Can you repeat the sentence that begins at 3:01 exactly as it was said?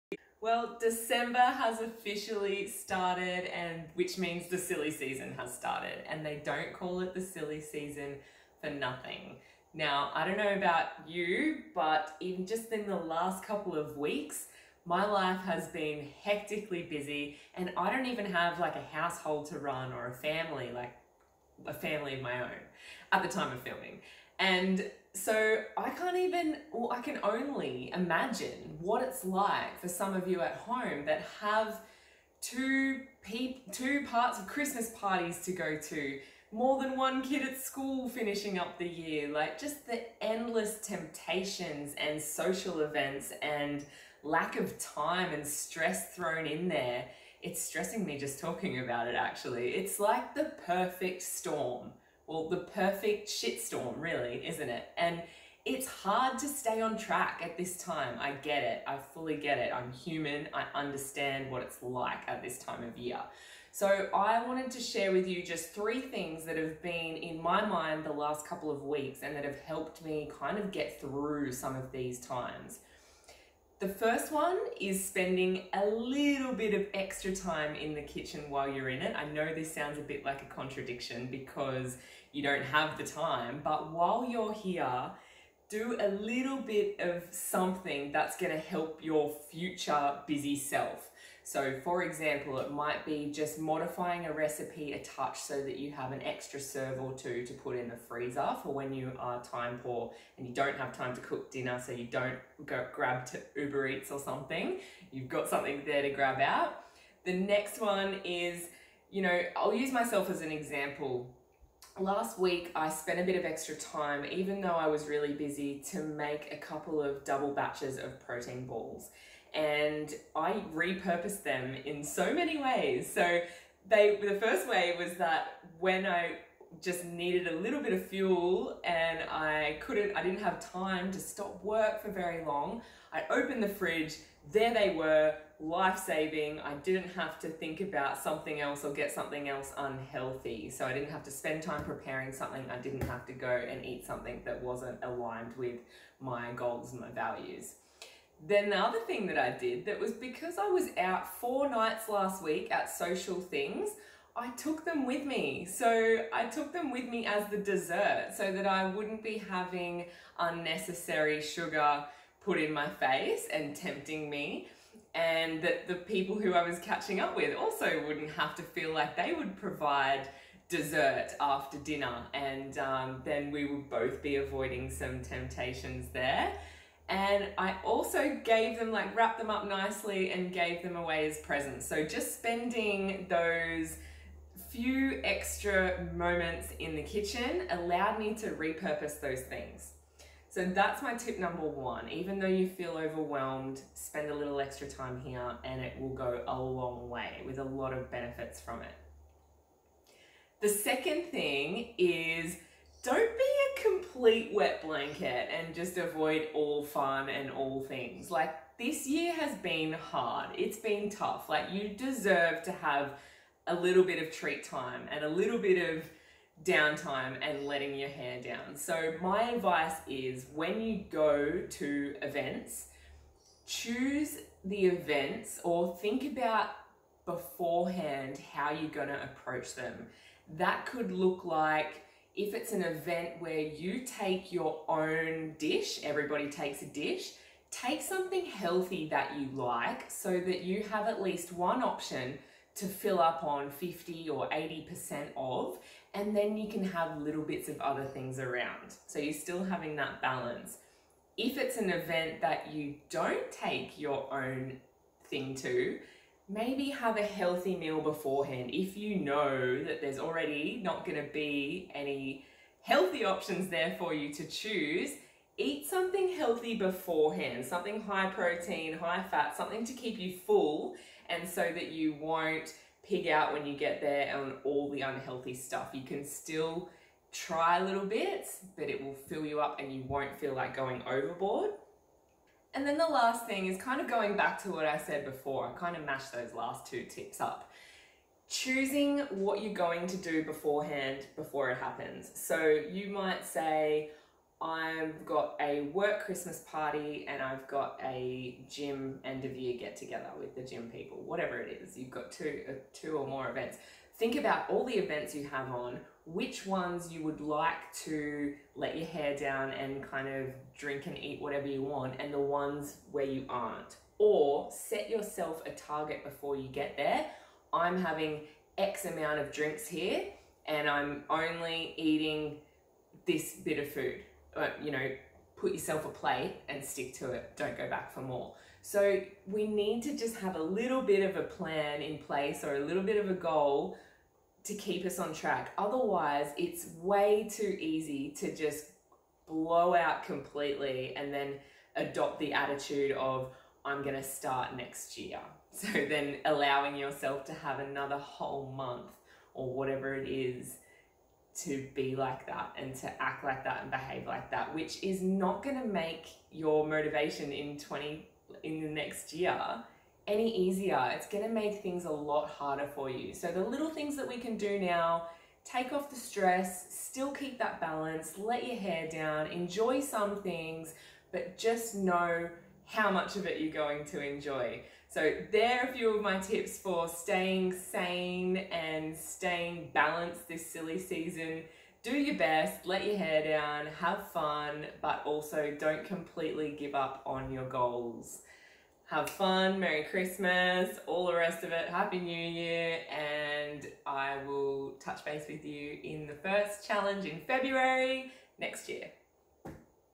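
So just spending those few extra moments in the kitchen allowed me to repurpose those things.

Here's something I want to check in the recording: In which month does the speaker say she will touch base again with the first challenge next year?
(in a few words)
February.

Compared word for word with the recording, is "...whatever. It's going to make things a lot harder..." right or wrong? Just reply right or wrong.
wrong.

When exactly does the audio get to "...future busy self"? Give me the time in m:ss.
1:29.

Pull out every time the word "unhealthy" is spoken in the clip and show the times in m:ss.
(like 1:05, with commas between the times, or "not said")
2:19, 4:35.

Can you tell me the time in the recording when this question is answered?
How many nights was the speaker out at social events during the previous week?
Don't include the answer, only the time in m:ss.
2:31.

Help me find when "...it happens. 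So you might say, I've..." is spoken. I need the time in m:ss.
4:51.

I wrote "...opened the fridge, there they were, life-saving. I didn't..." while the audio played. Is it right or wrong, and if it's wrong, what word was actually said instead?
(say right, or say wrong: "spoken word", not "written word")
right.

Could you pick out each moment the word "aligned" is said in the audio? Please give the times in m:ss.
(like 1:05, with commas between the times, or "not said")
2:25.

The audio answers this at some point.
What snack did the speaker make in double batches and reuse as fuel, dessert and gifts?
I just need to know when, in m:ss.
1:58.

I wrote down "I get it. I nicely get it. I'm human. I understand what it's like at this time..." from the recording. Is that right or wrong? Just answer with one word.
wrong.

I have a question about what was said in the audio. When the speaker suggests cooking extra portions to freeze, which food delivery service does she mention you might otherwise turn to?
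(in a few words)
Uber Eats.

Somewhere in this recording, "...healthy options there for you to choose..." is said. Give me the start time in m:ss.
4:22.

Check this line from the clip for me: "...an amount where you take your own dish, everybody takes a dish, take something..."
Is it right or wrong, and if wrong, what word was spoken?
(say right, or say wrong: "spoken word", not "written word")
wrong: "event", not "amount".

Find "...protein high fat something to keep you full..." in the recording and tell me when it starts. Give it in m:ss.
4:28.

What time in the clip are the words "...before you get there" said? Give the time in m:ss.
5:16.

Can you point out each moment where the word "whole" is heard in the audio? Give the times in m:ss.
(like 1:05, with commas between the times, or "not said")
5:48.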